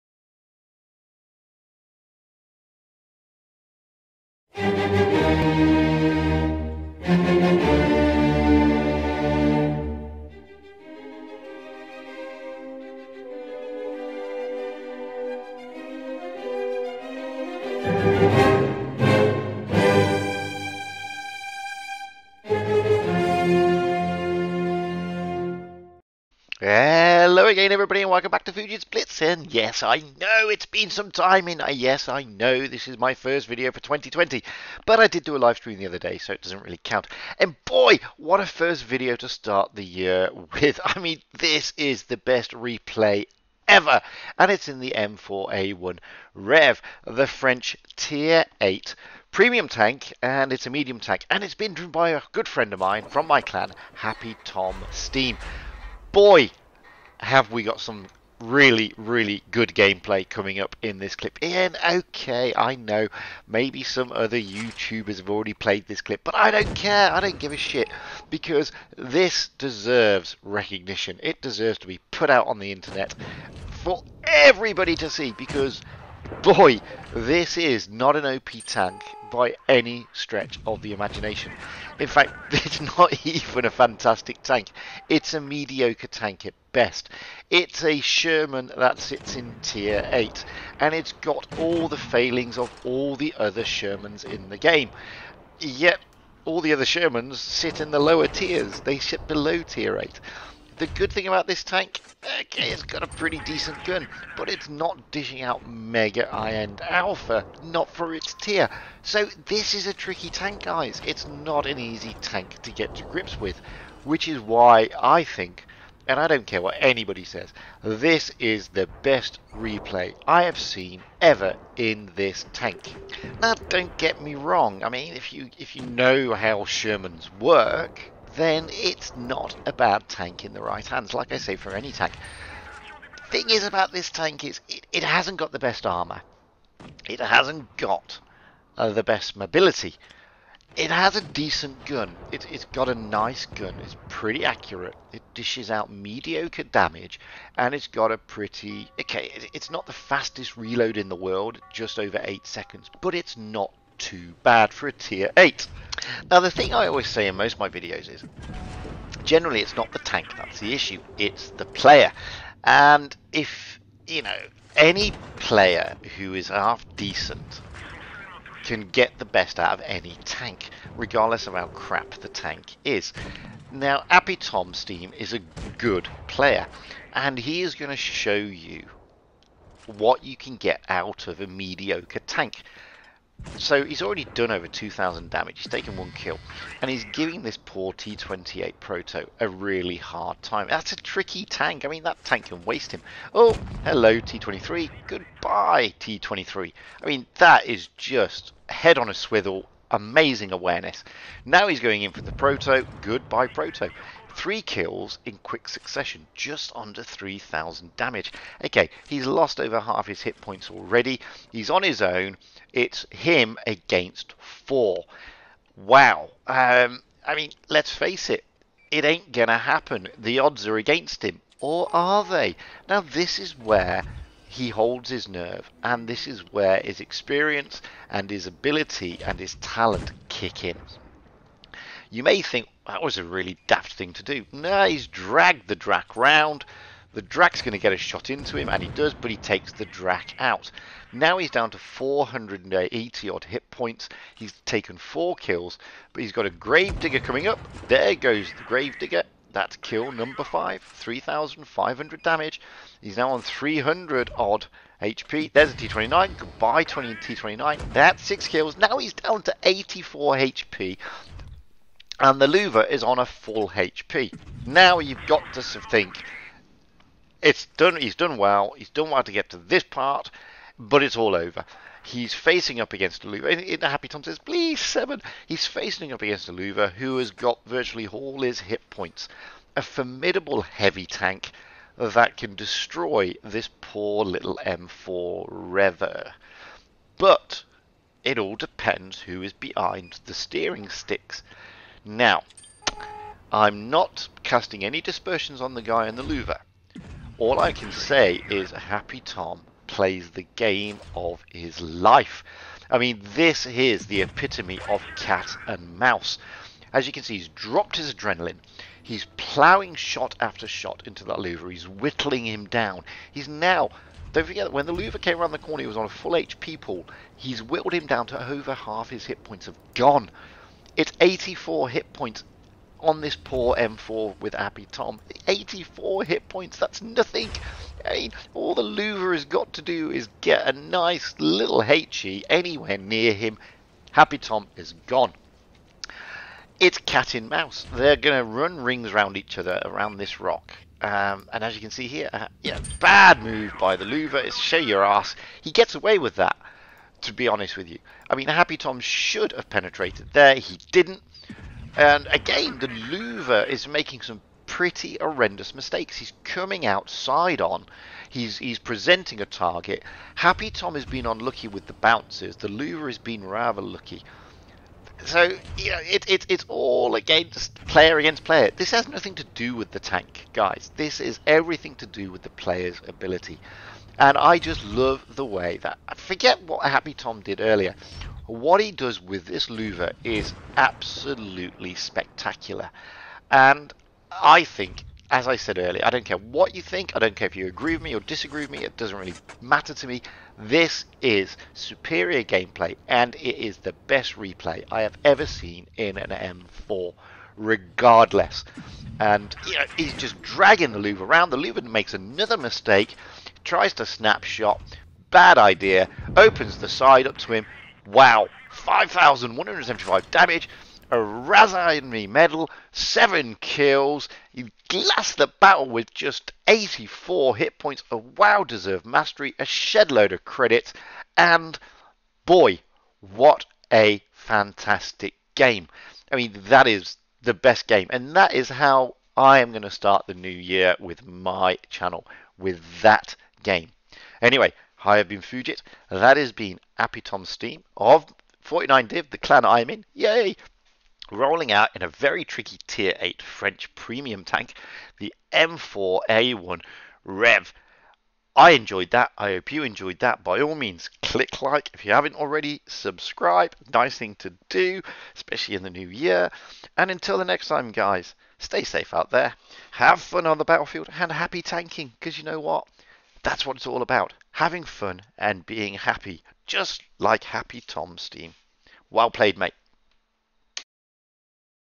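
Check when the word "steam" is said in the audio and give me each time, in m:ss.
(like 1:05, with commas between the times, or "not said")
0:54, 2:54, 7:17, 7:48.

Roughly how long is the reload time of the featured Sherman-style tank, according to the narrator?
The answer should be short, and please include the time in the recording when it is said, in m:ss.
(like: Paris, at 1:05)
Just over 8 seconds, at 2:31.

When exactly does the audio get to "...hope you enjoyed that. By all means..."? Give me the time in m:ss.
7:29.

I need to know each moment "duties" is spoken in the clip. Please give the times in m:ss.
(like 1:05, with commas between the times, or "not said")
not said.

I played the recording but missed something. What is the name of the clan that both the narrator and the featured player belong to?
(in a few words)
49Div.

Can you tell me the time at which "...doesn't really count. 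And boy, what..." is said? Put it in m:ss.
0:36.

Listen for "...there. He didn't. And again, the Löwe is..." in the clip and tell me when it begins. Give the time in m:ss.
5:50.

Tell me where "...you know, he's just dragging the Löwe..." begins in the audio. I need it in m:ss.
6:39.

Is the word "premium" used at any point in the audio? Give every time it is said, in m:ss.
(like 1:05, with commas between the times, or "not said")
0:49, 7:23.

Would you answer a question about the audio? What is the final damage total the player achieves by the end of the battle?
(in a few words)
5,175.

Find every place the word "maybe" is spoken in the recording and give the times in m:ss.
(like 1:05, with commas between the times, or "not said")
1:03.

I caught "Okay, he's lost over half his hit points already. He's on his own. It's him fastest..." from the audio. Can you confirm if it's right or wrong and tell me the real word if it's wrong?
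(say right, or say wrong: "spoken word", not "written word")
wrong: "against", not "fastest".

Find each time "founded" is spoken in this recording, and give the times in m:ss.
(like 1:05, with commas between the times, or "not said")
not said.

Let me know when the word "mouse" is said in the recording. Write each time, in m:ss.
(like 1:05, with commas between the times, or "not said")
5:05, 5:37.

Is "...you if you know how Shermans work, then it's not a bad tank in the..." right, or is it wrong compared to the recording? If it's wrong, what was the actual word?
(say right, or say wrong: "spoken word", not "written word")
right.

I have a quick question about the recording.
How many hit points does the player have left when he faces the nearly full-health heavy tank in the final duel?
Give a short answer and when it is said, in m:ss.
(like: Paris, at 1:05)
84, at 4:19.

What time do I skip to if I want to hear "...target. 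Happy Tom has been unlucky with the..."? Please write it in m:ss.
5:59.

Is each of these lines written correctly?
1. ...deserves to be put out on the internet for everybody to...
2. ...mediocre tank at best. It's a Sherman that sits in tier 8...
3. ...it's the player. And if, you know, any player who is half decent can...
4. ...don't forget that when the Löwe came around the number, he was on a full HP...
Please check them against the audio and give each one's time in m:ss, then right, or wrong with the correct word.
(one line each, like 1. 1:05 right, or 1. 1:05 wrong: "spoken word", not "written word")
1. 1:11 right
2. 1:25 right
3. 2:41 right
4. 5:14 wrong: "corner", not "number".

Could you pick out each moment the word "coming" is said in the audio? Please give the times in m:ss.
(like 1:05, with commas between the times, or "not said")
1:00, 4:07, 5:56.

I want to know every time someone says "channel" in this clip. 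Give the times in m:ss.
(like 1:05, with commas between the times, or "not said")
7:11.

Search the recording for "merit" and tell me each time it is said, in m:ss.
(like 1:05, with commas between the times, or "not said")
not said.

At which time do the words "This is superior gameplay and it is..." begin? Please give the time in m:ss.
6:30.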